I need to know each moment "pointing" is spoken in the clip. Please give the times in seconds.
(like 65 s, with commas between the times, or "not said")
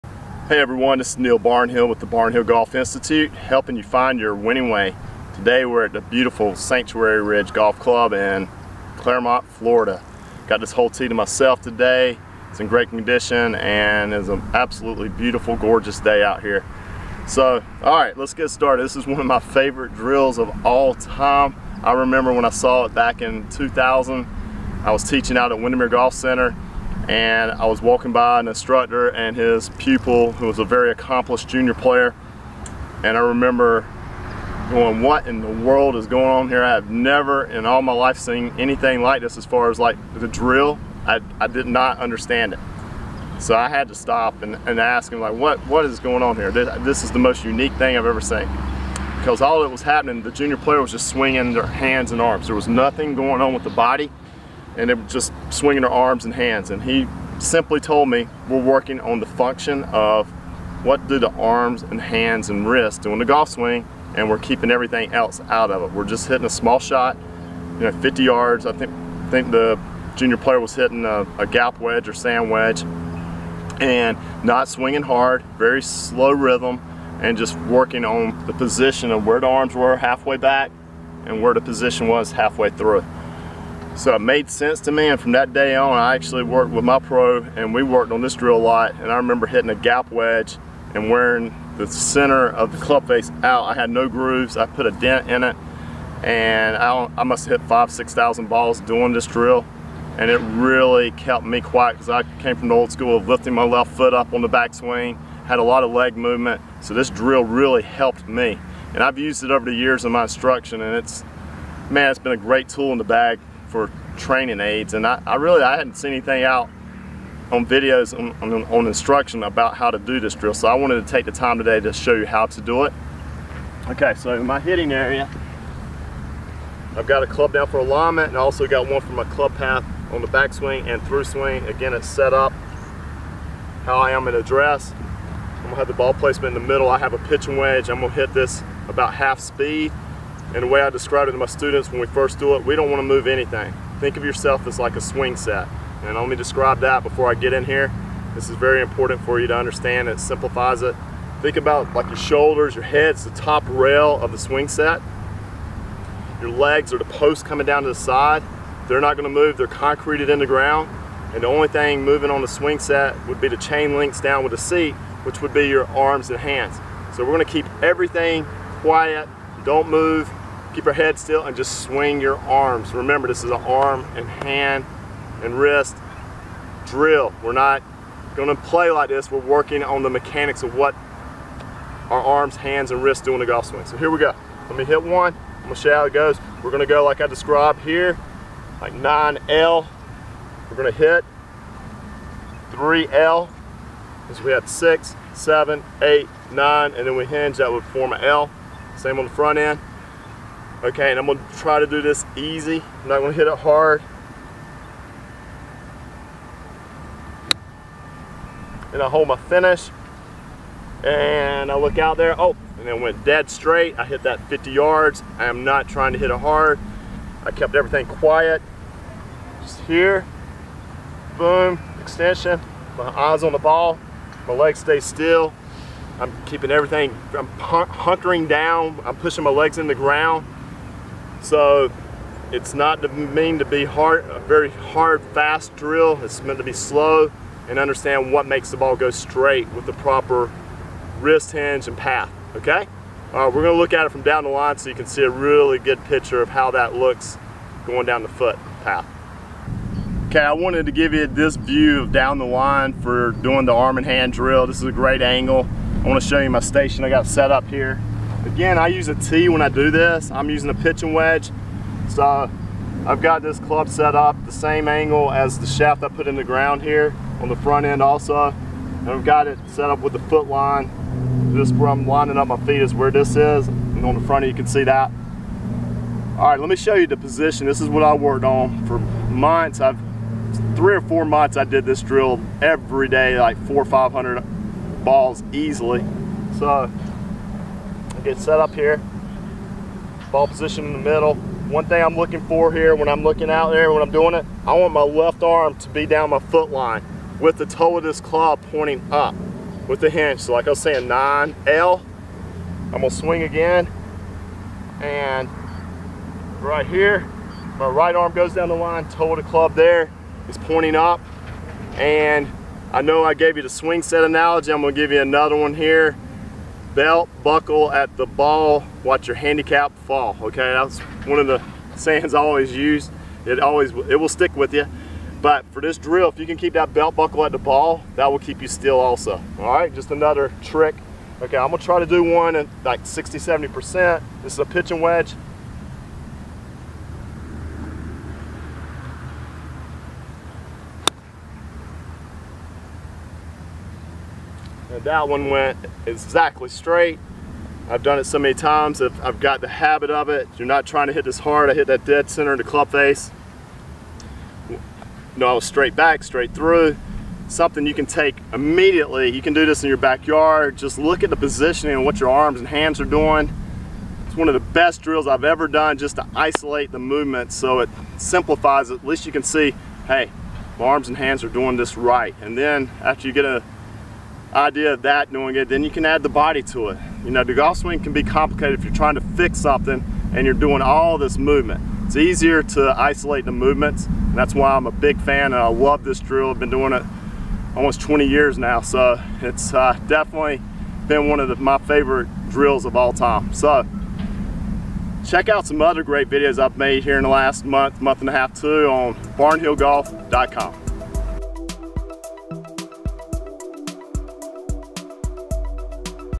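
298 s, 310 s.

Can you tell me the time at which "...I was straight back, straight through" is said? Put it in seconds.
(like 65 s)
355 s.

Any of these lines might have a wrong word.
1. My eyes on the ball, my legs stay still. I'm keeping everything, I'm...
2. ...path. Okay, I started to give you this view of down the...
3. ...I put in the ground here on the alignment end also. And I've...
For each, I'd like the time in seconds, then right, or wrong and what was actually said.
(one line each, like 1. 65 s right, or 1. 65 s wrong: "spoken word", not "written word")
1. 222 s right
2. 248 s wrong: "wanted", not "started"
3. 266 s wrong: "front", not "alignment".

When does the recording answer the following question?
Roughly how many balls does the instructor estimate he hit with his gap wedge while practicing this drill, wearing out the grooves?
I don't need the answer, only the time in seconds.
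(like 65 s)
97 s.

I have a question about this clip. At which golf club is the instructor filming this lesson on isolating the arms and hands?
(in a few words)
Sanctuary Ridge Golf Club.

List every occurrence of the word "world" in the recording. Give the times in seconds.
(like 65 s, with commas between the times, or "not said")
35 s.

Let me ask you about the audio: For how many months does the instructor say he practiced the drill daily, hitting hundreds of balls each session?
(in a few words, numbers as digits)
3 or 4 months.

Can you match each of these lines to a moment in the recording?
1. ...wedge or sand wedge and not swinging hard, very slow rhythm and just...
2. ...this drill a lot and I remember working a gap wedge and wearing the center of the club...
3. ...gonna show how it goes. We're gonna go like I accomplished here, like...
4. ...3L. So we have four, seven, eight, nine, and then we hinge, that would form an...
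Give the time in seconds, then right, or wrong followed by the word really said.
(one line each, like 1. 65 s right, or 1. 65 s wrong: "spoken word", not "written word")
1. 71 s right
2. 88 s wrong: "hitting", not "working"
3. 185 s wrong: "described", not "accomplished"
4. 192 s wrong: "six", not "four".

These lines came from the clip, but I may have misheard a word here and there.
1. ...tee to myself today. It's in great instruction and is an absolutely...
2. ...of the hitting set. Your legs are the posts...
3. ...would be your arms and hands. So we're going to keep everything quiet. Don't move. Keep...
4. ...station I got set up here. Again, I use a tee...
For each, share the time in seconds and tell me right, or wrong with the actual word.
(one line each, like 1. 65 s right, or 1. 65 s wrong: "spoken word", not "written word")
1. 10 s wrong: "condition", not "instruction"
2. 154 s wrong: "swing", not "hitting"
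3. 165 s right
4. 256 s right.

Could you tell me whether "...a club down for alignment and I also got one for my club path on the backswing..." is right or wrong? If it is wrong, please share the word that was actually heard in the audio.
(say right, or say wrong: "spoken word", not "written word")
right.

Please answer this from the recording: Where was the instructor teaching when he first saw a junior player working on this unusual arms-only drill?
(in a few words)
Windermere Golf Center.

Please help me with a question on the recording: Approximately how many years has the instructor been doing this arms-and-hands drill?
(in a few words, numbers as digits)
Almost 20.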